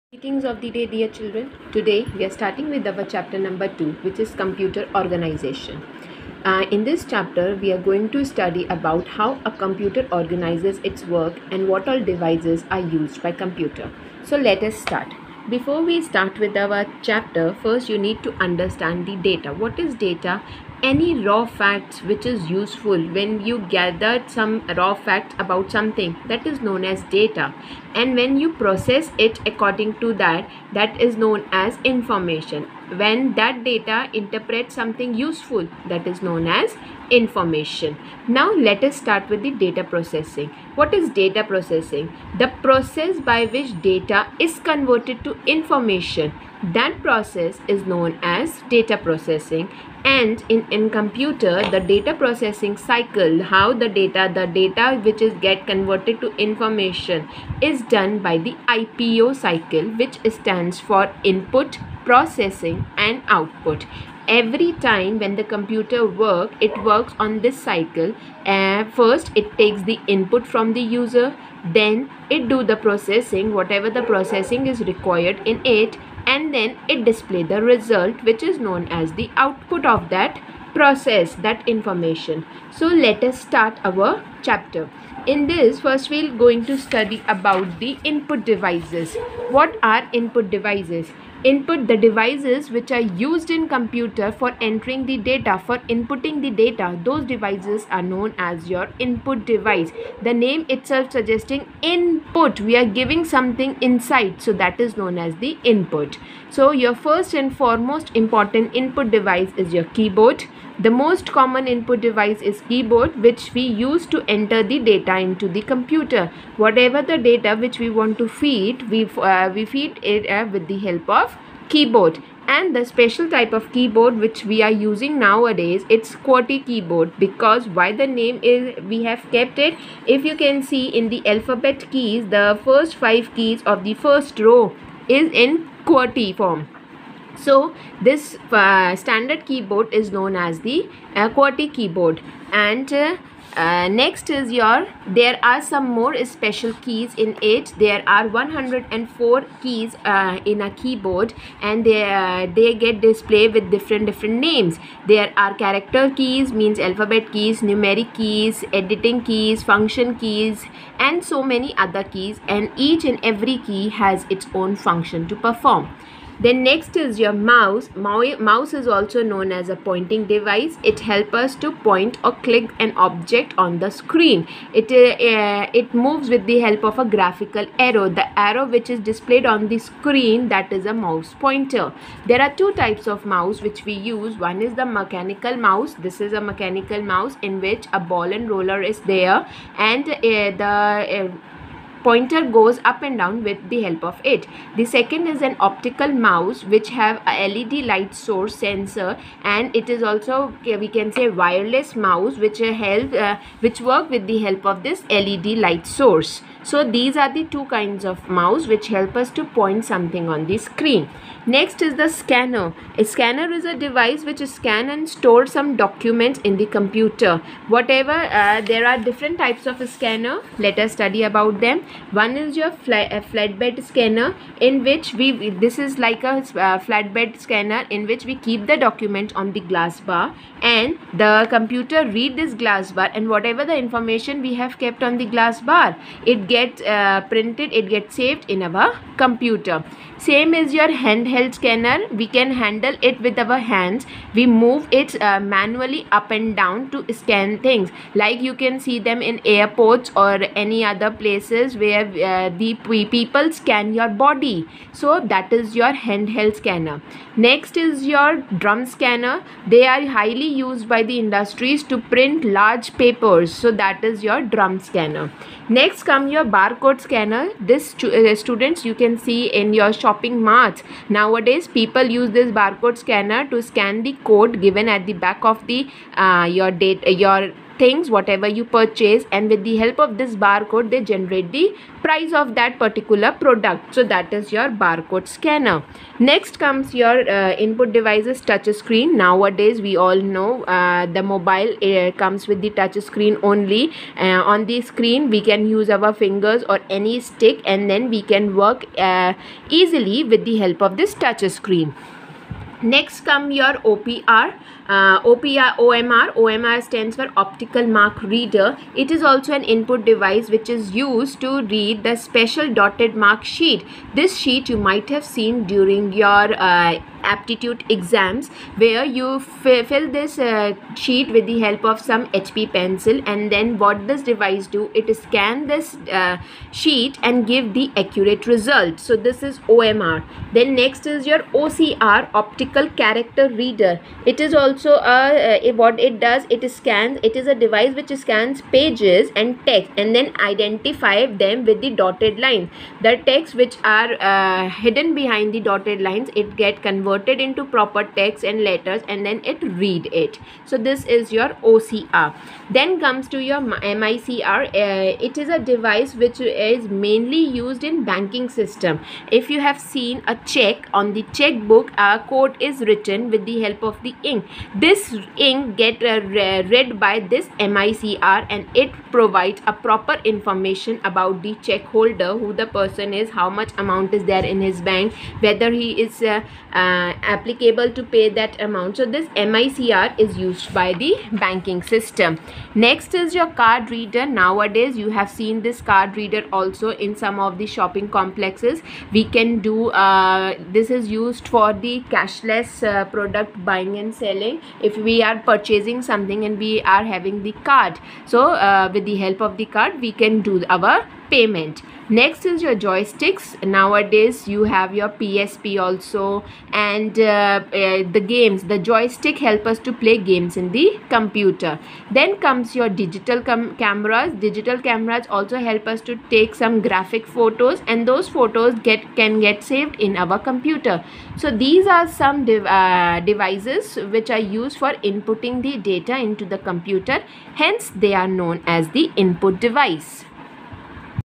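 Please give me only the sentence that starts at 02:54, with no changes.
It, uh, uh, it moves with the help of a graphical arrow.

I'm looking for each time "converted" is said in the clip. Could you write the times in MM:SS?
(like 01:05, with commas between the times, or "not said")
00:44, 00:55, 05:46.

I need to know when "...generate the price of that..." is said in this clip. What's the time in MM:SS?
04:41.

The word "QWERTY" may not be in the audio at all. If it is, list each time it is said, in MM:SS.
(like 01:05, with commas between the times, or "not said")
02:06, 02:15, 02:21.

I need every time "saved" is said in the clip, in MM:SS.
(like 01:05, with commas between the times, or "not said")
03:58, 06:59.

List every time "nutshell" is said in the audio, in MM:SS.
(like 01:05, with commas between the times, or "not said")
not said.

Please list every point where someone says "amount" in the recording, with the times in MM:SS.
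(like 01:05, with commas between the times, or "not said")
06:13, 06:18.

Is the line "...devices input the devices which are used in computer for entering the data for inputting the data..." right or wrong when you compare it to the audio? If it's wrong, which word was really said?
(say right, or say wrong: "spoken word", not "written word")
right.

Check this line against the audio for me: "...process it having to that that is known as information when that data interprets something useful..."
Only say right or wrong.
wrong.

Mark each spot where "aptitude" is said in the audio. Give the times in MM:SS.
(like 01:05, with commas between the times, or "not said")
05:17.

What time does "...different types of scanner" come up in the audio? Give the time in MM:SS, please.
03:38.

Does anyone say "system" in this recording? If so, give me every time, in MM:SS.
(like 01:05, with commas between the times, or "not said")
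05:58, 06:21.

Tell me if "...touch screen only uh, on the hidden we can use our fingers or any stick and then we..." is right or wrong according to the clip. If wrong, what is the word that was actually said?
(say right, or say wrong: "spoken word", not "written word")
wrong: "screen", not "hidden".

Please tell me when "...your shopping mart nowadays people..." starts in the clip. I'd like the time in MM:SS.
04:29.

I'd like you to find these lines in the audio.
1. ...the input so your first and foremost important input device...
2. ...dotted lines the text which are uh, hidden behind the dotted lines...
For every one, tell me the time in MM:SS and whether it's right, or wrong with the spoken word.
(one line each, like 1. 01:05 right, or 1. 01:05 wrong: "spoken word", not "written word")
1. 01:45 right
2. 05:41 right.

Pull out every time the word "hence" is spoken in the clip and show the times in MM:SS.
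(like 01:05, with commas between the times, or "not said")
07:07.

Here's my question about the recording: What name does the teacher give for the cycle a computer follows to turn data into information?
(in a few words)
IPO cycle.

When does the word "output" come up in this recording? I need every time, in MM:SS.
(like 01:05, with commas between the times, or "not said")
01:03, 01:19.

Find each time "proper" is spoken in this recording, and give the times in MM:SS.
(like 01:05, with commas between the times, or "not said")
05:47, 06:09.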